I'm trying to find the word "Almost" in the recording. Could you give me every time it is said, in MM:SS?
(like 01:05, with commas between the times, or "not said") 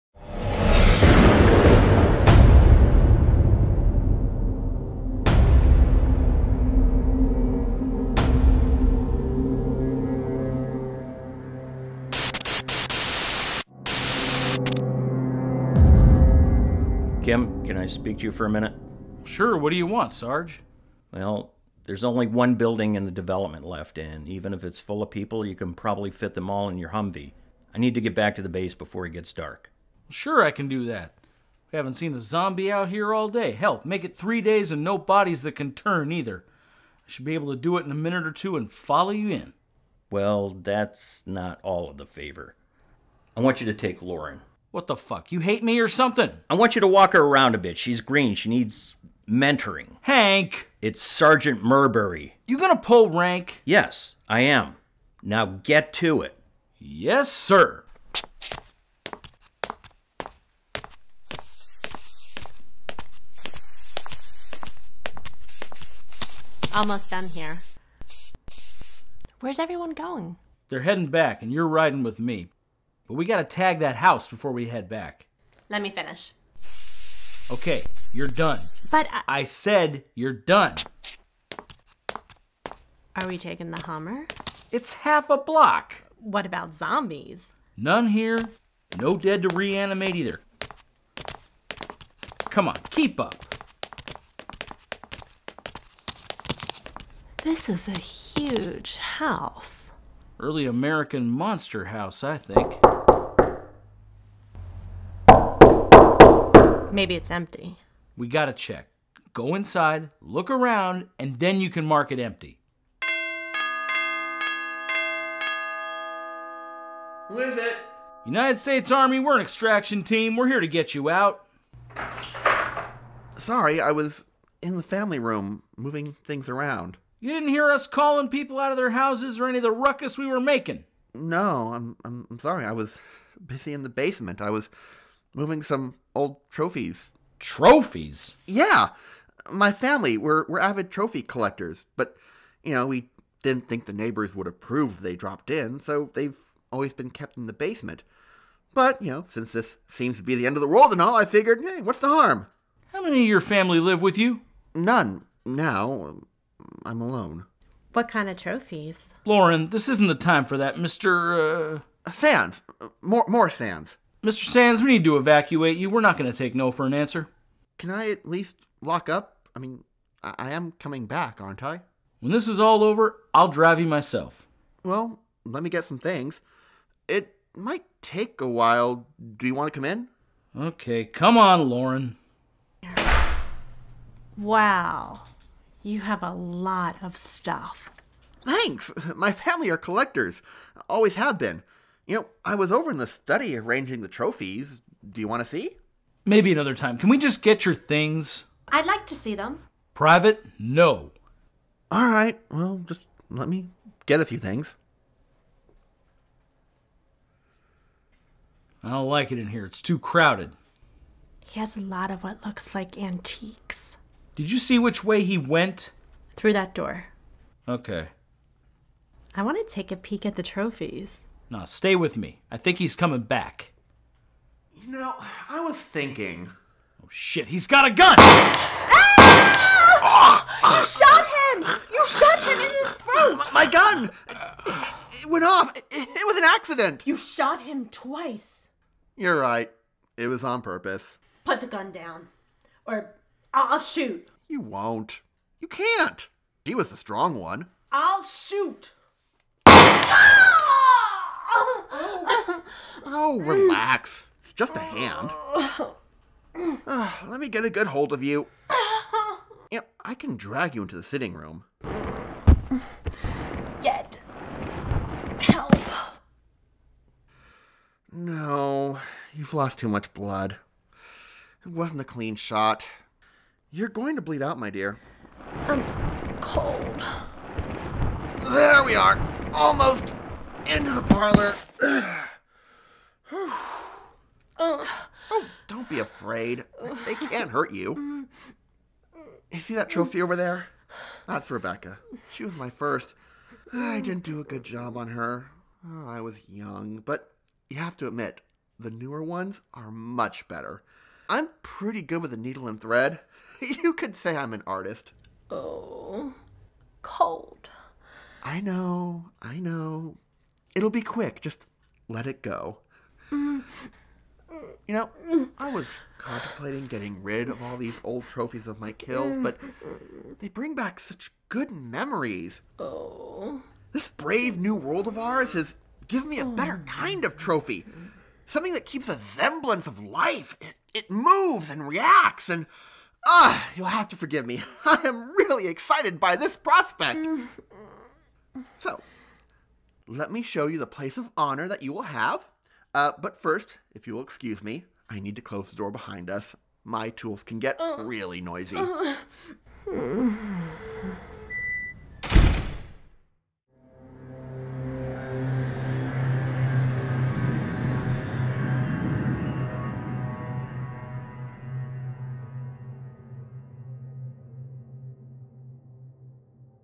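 01:06, 04:39.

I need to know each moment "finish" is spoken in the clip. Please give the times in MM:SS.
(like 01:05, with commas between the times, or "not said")
01:15.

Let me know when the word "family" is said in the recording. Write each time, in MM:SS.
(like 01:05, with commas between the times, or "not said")
02:04, 02:19, 02:33, 03:09.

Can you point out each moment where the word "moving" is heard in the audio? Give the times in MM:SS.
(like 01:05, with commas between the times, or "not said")
02:05, 02:15.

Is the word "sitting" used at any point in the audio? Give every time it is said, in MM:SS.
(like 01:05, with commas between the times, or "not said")
04:21.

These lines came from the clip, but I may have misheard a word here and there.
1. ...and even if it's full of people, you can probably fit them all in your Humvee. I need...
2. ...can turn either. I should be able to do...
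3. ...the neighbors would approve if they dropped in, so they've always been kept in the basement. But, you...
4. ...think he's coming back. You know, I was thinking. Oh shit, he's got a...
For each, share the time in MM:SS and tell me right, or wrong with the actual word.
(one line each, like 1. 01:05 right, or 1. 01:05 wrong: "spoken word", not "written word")
1. 00:23 right
2. 00:35 right
3. 02:23 right
4. 03:42 right.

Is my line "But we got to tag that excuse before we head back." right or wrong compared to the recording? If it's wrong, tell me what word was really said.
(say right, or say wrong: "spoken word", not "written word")
wrong: "house", not "excuse".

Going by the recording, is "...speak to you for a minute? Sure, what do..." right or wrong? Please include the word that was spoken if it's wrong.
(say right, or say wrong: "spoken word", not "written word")
right.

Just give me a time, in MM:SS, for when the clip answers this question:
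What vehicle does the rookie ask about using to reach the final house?
01:23.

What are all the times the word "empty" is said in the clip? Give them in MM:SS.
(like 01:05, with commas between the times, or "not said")
01:47, 01:52.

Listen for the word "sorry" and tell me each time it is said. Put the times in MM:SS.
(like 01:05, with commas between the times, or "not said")
02:03, 02:12.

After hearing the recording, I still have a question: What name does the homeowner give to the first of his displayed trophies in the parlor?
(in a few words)
Rebecca.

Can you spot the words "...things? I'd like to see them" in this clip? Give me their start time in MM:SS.
03:17.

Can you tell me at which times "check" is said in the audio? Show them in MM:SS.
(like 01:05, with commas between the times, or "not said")
01:48.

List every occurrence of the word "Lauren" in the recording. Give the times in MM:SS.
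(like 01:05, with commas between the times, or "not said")
00:44, 02:39, 03:01.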